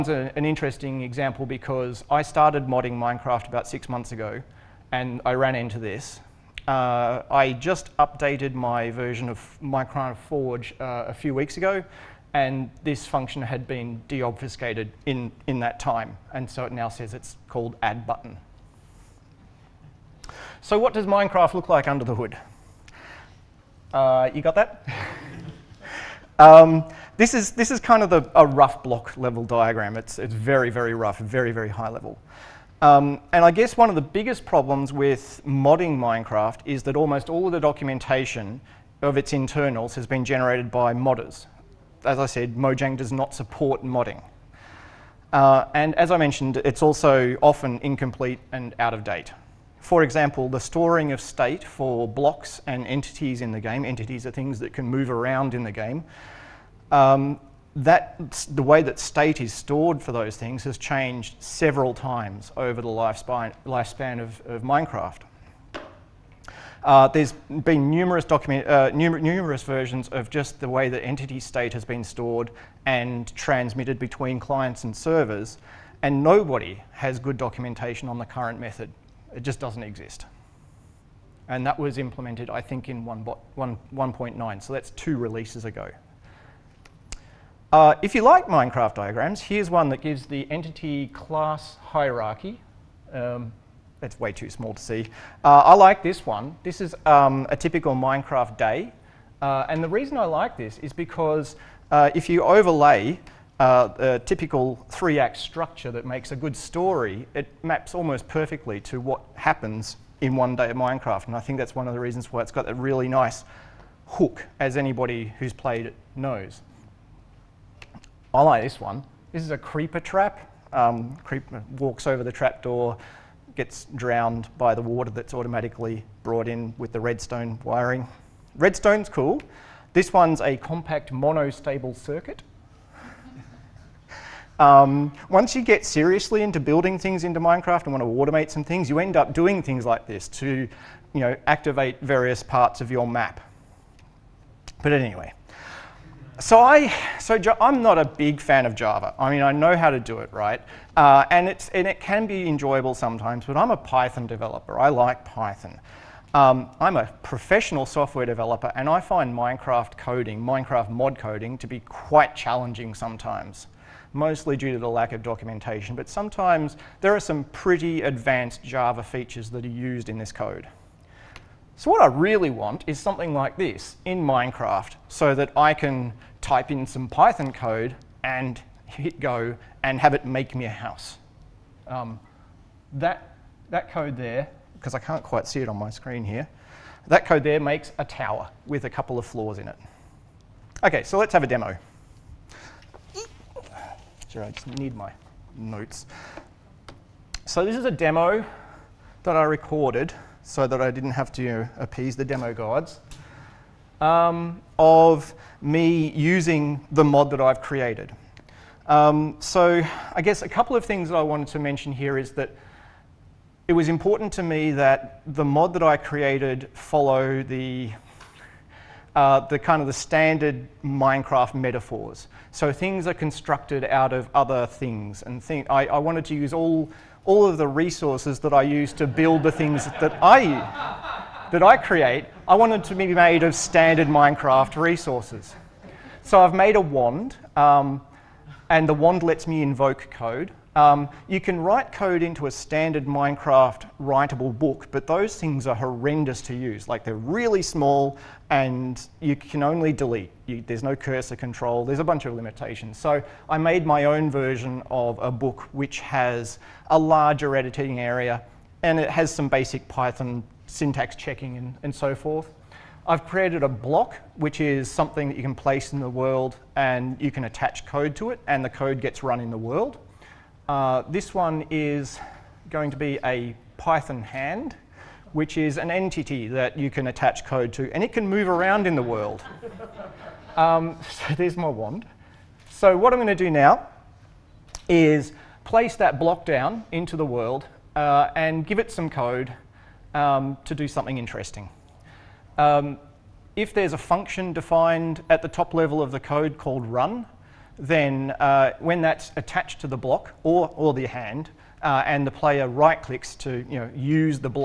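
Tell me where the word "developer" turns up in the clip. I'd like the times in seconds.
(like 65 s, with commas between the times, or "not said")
154 s, 158 s.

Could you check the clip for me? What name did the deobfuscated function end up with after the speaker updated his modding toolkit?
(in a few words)
add button.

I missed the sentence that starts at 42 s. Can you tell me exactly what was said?
As I said, Mojang does not support modding.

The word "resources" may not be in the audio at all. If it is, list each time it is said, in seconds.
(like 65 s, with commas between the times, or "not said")
227 s, 234 s.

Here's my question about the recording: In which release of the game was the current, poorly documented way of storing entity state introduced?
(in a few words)
1.9.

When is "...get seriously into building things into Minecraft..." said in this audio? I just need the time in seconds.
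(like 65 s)
135 s.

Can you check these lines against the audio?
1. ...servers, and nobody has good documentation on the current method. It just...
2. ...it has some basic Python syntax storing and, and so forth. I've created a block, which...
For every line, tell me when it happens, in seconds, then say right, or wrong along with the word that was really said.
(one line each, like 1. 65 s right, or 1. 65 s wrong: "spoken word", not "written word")
1. 74 s right
2. 258 s wrong: "checking", not "storing".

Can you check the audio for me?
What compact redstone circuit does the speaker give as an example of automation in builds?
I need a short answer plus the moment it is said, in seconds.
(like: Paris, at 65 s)
monostable circuit, at 130 s.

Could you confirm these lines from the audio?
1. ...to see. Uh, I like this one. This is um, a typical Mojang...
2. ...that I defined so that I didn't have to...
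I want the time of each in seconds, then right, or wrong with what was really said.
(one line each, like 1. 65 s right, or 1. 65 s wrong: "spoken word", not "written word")
1. 94 s wrong: "Minecraft", not "Mojang"
2. 199 s wrong: "recorded", not "defined".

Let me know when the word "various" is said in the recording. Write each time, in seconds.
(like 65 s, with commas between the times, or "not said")
142 s.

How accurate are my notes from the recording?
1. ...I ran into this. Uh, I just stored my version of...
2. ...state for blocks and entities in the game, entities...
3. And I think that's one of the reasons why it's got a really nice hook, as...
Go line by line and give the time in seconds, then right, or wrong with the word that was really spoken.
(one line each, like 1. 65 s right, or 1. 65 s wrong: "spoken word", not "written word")
1. 5 s wrong: "updated", not "stored"
2. 51 s right
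3. 111 s right.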